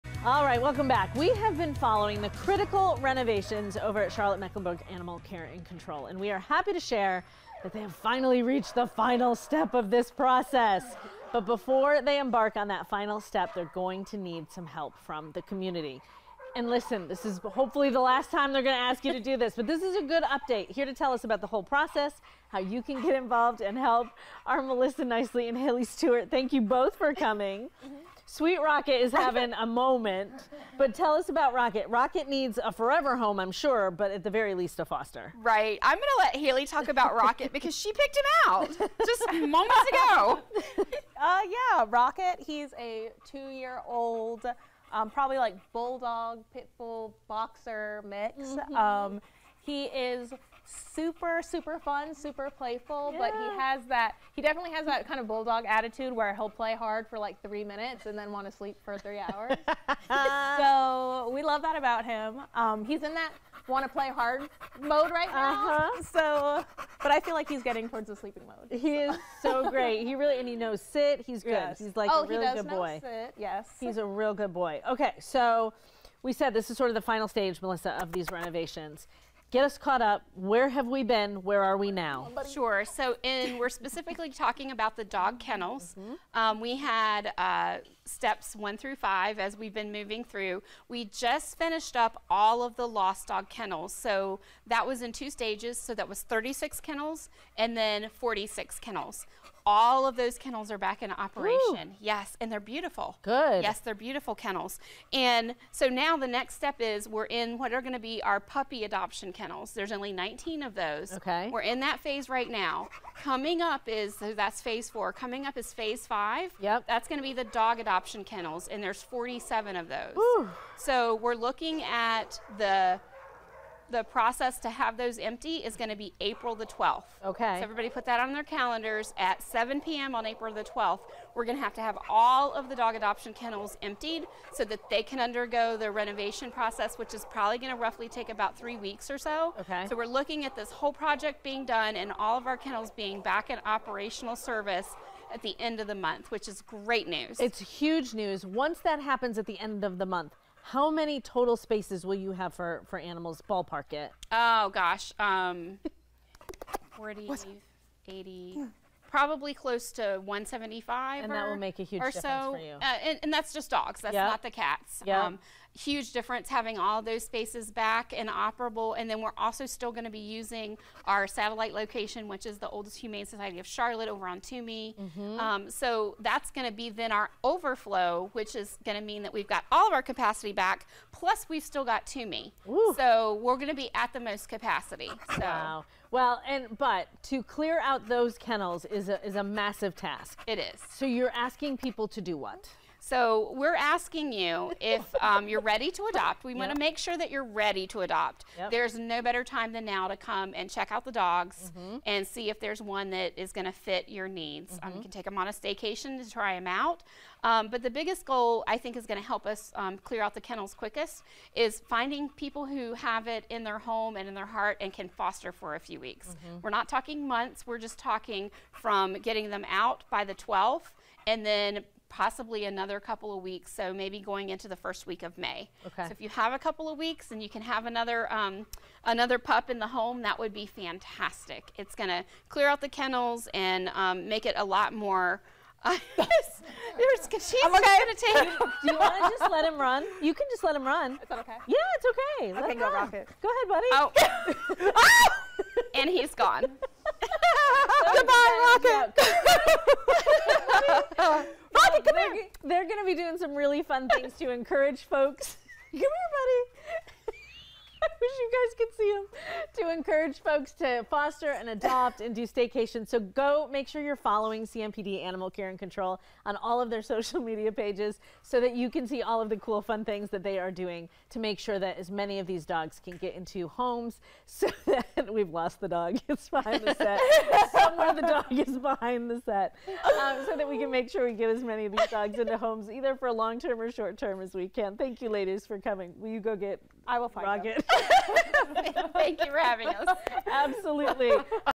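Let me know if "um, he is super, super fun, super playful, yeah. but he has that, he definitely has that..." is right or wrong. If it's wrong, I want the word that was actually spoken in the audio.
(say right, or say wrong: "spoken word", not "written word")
right.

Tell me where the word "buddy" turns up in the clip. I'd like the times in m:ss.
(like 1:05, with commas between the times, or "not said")
4:04, 4:16.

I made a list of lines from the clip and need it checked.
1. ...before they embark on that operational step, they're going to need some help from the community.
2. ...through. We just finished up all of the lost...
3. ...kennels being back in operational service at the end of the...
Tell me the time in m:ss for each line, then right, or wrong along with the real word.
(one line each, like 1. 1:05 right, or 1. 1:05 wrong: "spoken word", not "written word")
1. 0:11 wrong: "final", not "operational"
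2. 1:30 right
3. 2:22 right.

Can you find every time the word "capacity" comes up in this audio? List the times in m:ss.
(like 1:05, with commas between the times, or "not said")
3:00, 3:04.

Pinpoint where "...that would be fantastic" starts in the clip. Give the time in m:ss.
3:50.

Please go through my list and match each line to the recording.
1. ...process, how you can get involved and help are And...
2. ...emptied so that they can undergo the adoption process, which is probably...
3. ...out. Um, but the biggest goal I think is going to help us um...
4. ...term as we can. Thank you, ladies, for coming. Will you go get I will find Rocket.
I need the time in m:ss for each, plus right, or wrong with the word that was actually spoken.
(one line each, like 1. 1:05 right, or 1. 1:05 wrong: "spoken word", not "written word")
1. 0:21 wrong: "Melissa", not "And"
2. 2:13 wrong: "renovation", not "adoption"
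3. 3:26 right
4. 4:44 right.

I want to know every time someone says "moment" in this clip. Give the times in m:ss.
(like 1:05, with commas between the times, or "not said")
0:29, 0:39.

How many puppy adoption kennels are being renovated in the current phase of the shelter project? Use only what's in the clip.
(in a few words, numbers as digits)
19.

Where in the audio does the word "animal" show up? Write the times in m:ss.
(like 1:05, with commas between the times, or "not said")
0:04, 2:32, 4:25.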